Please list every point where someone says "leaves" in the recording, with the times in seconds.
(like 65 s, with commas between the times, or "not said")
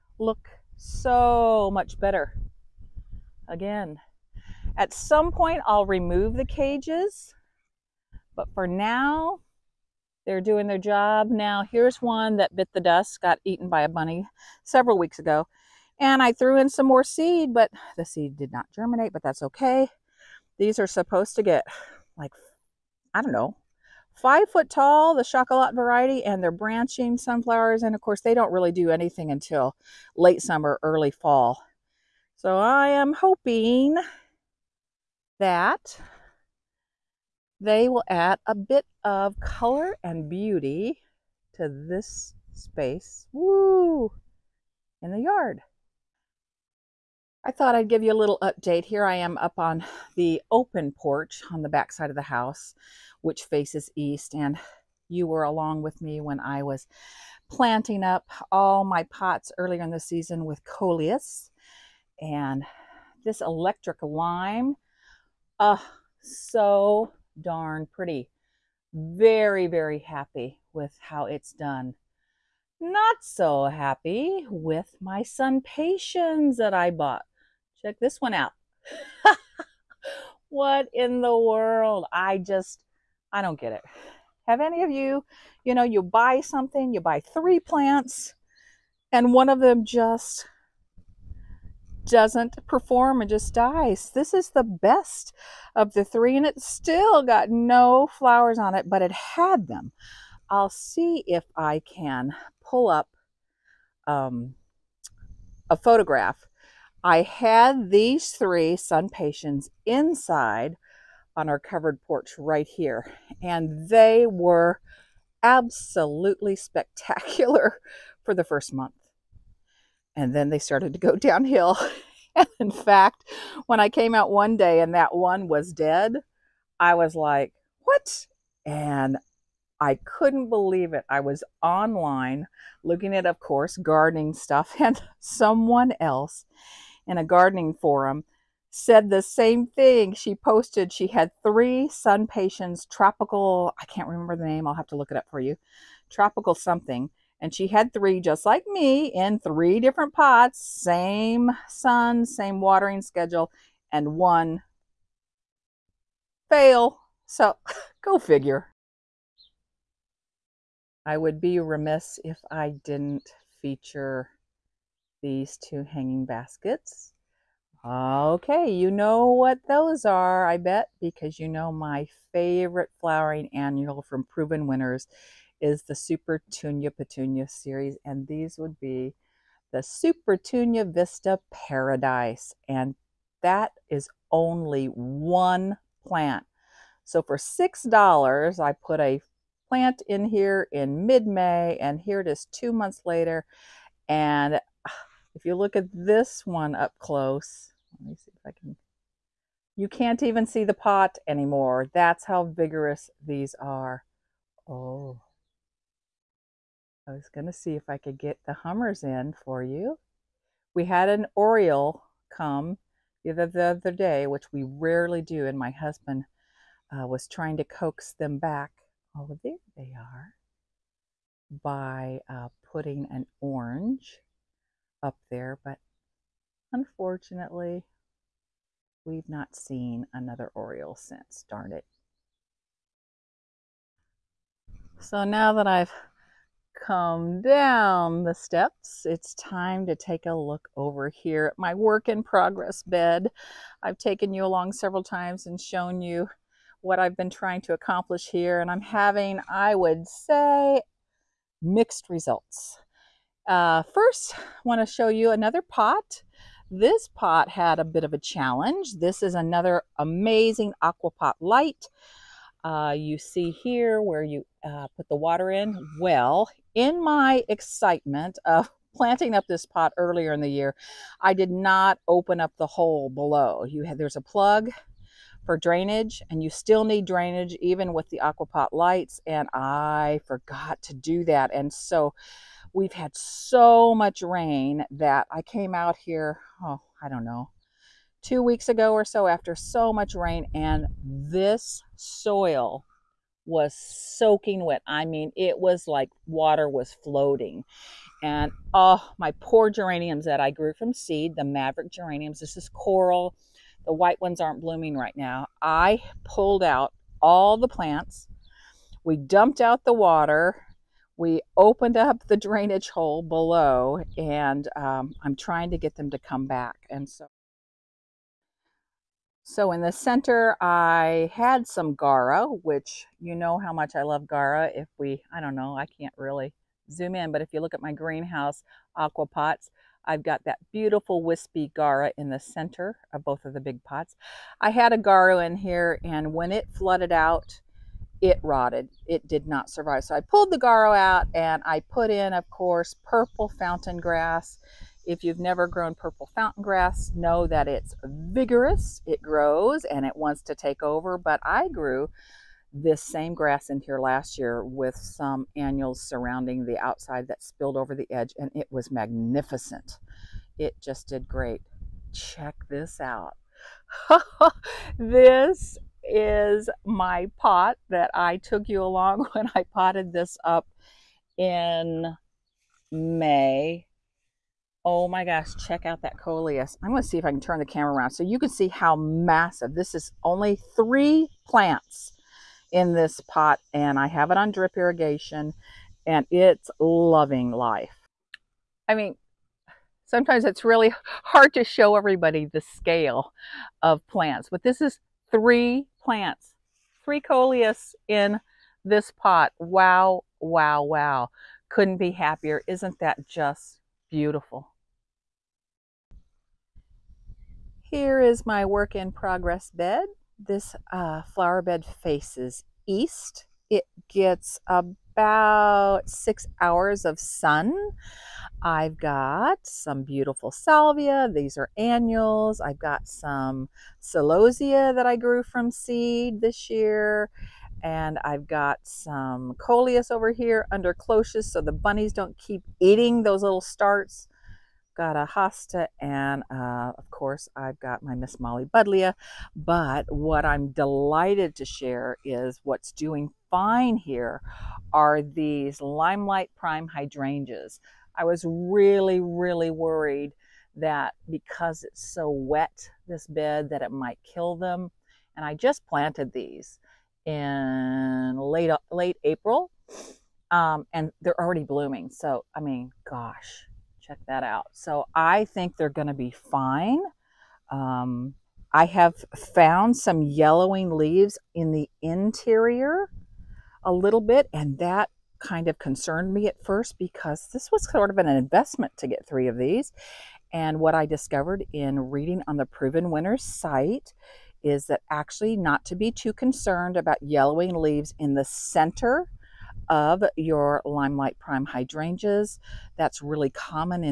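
470 s, 487 s.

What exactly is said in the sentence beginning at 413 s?
It gets about six hours of sun.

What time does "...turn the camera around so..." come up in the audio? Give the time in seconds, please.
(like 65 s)
377 s.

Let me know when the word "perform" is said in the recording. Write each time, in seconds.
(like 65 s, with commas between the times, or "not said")
92 s.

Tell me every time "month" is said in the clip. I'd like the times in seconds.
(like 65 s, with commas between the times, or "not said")
118 s, 192 s.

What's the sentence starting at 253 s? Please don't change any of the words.
Uh, first, want to show you another pot.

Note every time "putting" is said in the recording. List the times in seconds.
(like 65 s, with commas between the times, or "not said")
222 s.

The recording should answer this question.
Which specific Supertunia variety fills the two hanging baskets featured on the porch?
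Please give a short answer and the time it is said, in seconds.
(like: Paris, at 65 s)
Supertunia Vista Paradise, at 179 s.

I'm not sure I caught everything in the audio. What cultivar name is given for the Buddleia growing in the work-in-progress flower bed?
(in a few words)
Miss Molly.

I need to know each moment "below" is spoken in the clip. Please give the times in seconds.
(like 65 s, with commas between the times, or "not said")
273 s, 313 s.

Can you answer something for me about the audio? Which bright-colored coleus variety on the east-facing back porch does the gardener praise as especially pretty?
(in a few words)
Electric lime.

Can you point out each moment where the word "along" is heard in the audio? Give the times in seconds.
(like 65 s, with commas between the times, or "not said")
55 s, 244 s, 368 s.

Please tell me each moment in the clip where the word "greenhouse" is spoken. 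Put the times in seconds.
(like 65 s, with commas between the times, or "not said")
327 s.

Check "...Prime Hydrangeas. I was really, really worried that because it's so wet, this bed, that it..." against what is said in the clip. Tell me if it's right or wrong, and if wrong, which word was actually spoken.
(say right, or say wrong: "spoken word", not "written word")
right.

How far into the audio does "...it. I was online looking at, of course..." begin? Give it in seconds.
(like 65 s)
130 s.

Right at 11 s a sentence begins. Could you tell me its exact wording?
Now here's one that bit the dust, got eaten by a bunny several weeks ago.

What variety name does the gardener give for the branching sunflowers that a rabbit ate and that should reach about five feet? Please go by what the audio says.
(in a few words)
Chocolat.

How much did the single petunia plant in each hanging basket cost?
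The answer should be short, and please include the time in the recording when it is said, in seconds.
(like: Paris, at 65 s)
$6, at 187 s.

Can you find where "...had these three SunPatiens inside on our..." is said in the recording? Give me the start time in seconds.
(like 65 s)
107 s.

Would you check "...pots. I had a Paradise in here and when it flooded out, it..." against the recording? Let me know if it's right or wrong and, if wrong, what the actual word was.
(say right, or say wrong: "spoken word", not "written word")
wrong: "Gaura", not "Paradise".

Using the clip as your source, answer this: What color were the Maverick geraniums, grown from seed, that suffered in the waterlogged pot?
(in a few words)
Coral.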